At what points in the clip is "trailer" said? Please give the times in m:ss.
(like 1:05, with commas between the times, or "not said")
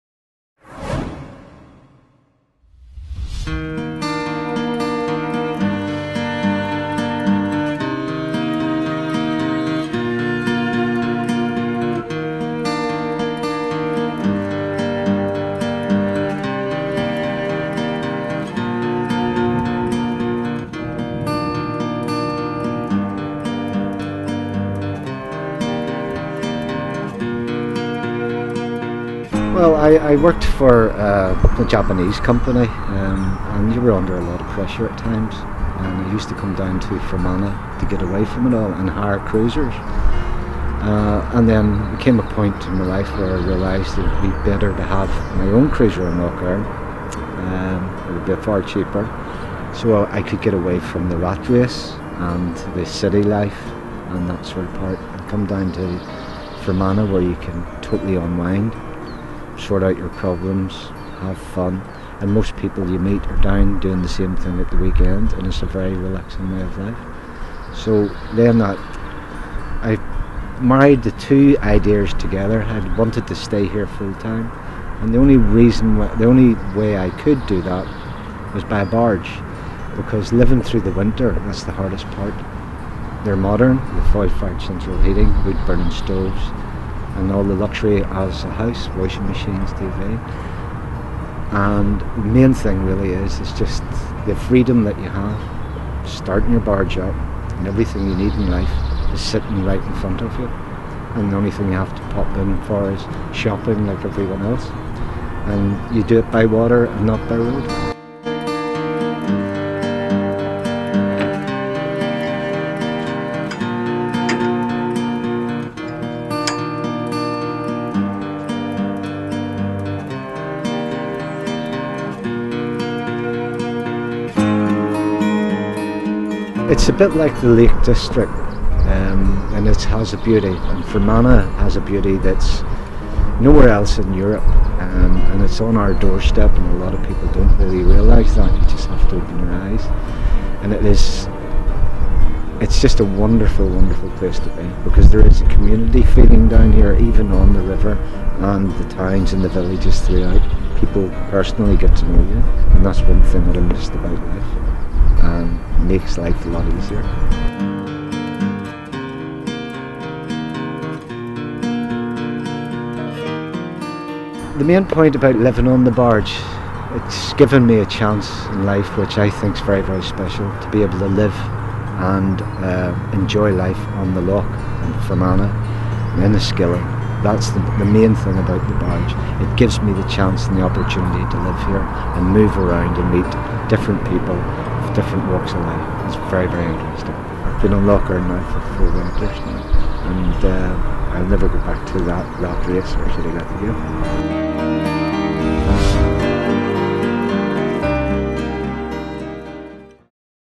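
not said.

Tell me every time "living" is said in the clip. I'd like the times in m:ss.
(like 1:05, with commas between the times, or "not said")
1:20, 2:45.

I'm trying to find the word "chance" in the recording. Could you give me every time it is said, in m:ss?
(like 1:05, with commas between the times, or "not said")
2:47, 3:00.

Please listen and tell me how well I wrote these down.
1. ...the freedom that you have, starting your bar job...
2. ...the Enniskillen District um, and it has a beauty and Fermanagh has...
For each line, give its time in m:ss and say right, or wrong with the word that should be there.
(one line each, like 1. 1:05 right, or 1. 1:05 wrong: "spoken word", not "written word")
1. 1:34 right
2. 2:07 wrong: "Lake", not "Enniskillen".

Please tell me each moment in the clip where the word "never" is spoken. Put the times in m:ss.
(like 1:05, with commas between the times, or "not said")
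3:11.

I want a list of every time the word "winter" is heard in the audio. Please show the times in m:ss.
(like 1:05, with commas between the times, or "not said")
1:20, 3:08.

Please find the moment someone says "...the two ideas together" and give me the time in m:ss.
1:11.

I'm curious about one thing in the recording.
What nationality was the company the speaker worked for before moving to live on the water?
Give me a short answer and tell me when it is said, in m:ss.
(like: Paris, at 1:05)
Japanese, at 0:31.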